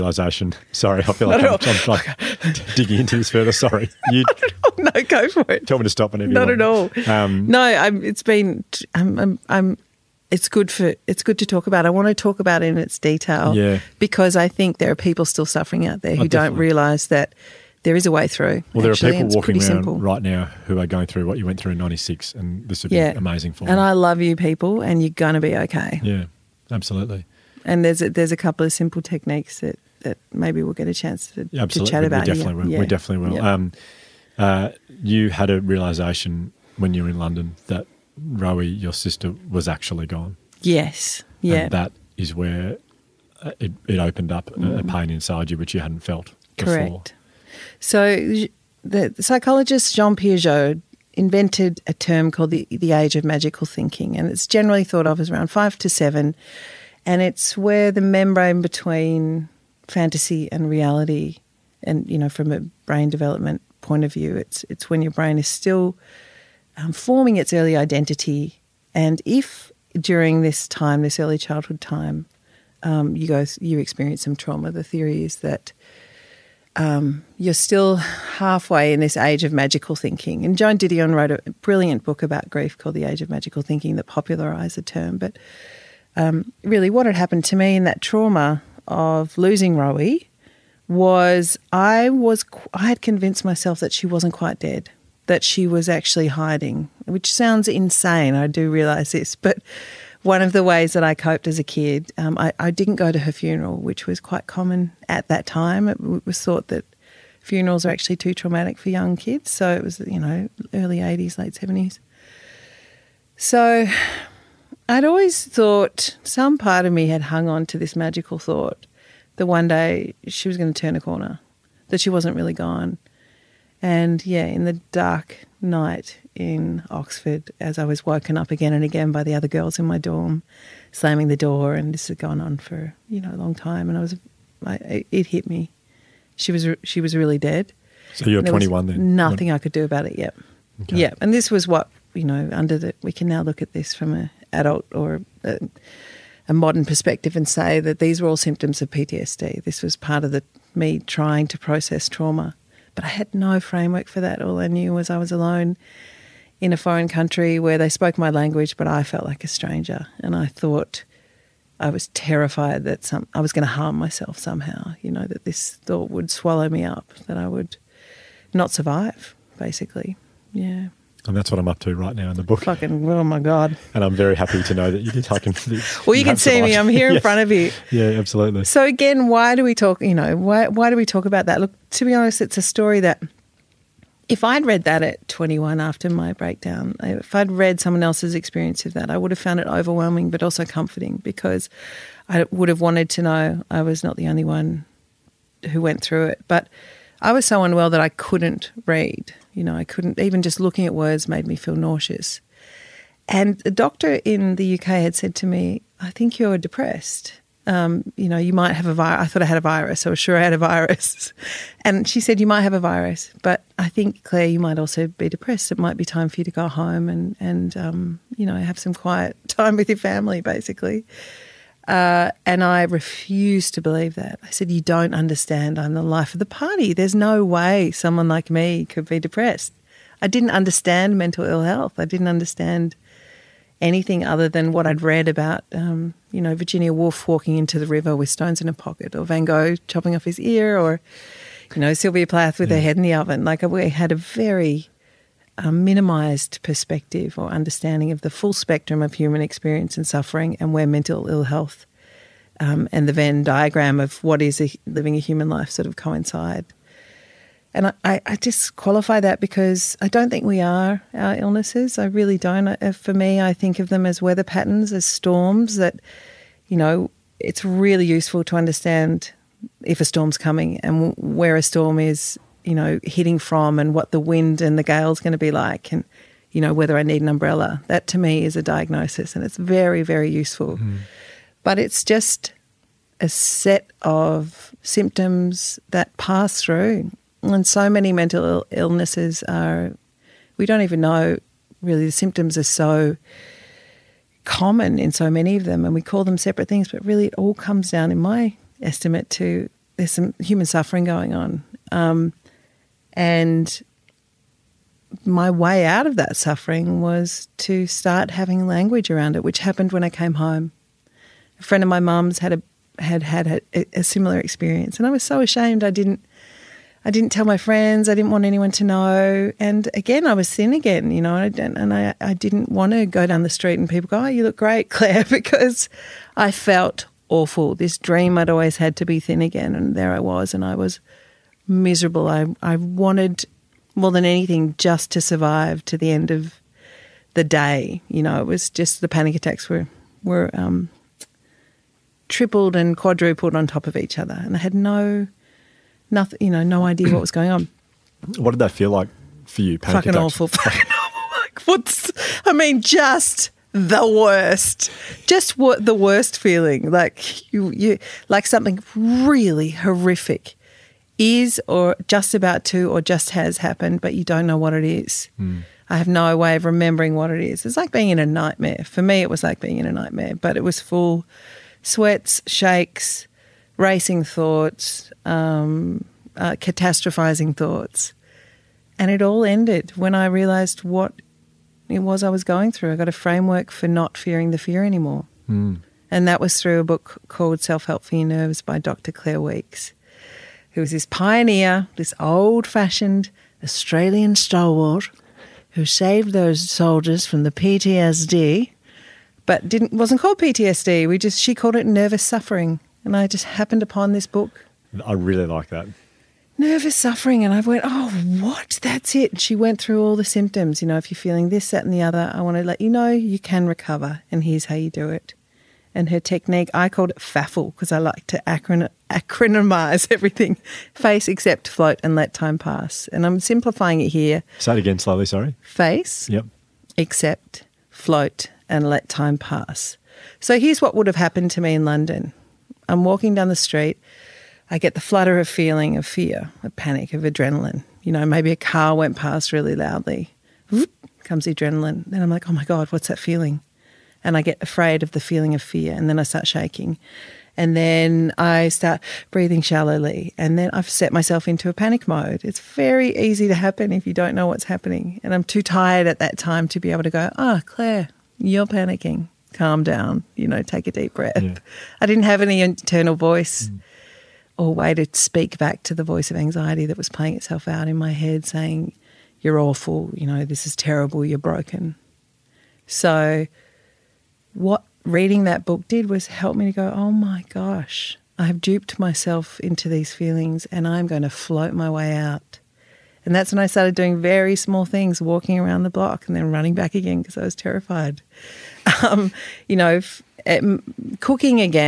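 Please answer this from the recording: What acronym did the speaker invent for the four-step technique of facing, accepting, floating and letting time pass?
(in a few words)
FAFL.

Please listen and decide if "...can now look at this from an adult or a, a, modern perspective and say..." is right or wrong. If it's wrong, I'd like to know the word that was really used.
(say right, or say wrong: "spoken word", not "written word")
right.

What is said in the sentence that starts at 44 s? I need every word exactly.
a pain inside you which you hadn't felt Correct.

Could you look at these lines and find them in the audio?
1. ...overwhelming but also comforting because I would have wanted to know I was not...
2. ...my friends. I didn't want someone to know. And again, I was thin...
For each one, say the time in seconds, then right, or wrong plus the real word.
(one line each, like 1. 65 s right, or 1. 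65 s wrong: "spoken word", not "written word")
1. 189 s right
2. 317 s wrong: "anyone", not "someone".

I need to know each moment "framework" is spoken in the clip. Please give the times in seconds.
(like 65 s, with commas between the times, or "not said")
153 s, 383 s.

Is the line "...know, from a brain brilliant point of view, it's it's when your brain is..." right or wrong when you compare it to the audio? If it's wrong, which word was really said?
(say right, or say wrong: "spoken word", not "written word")
wrong: "development", not "brilliant".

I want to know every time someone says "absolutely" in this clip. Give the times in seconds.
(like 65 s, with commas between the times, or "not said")
26 s, 178 s.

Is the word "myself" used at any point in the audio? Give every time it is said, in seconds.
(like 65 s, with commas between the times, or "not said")
93 s, 163 s, 451 s, 478 s.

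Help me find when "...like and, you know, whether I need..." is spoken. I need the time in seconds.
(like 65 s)
275 s.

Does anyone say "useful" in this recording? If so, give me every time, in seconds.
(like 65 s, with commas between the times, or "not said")
268 s, 280 s.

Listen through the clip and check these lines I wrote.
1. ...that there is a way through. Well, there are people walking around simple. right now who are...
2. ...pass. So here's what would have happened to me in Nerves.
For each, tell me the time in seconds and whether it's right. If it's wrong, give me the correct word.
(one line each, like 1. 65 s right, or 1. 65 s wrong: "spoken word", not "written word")
1. 17 s right
2. 429 s wrong: "London", not "Nerves".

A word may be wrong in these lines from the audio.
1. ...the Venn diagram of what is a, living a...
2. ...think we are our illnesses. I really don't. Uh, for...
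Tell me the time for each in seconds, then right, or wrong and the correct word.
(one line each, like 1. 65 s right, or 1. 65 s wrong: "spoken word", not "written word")
1. 253 s right
2. 260 s right.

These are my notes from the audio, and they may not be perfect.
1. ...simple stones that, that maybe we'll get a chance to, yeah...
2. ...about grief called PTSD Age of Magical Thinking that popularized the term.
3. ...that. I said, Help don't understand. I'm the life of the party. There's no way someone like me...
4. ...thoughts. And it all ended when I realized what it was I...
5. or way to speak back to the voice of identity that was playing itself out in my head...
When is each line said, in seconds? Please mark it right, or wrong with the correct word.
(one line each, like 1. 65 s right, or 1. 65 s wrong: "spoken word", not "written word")
1. 28 s wrong: "techniques", not "stones"
2. 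82 s wrong: "The", not "PTSD"
3. 224 s wrong: "You", not "Help"
4. 377 s right
5. 464 s wrong: "anxiety", not "identity".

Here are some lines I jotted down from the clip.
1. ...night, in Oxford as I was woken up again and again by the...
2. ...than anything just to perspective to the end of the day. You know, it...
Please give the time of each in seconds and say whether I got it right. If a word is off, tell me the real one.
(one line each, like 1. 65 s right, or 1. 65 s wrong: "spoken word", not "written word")
1. 125 s right
2. 334 s wrong: "survive", not "perspective".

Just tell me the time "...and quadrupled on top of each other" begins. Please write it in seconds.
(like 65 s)
342 s.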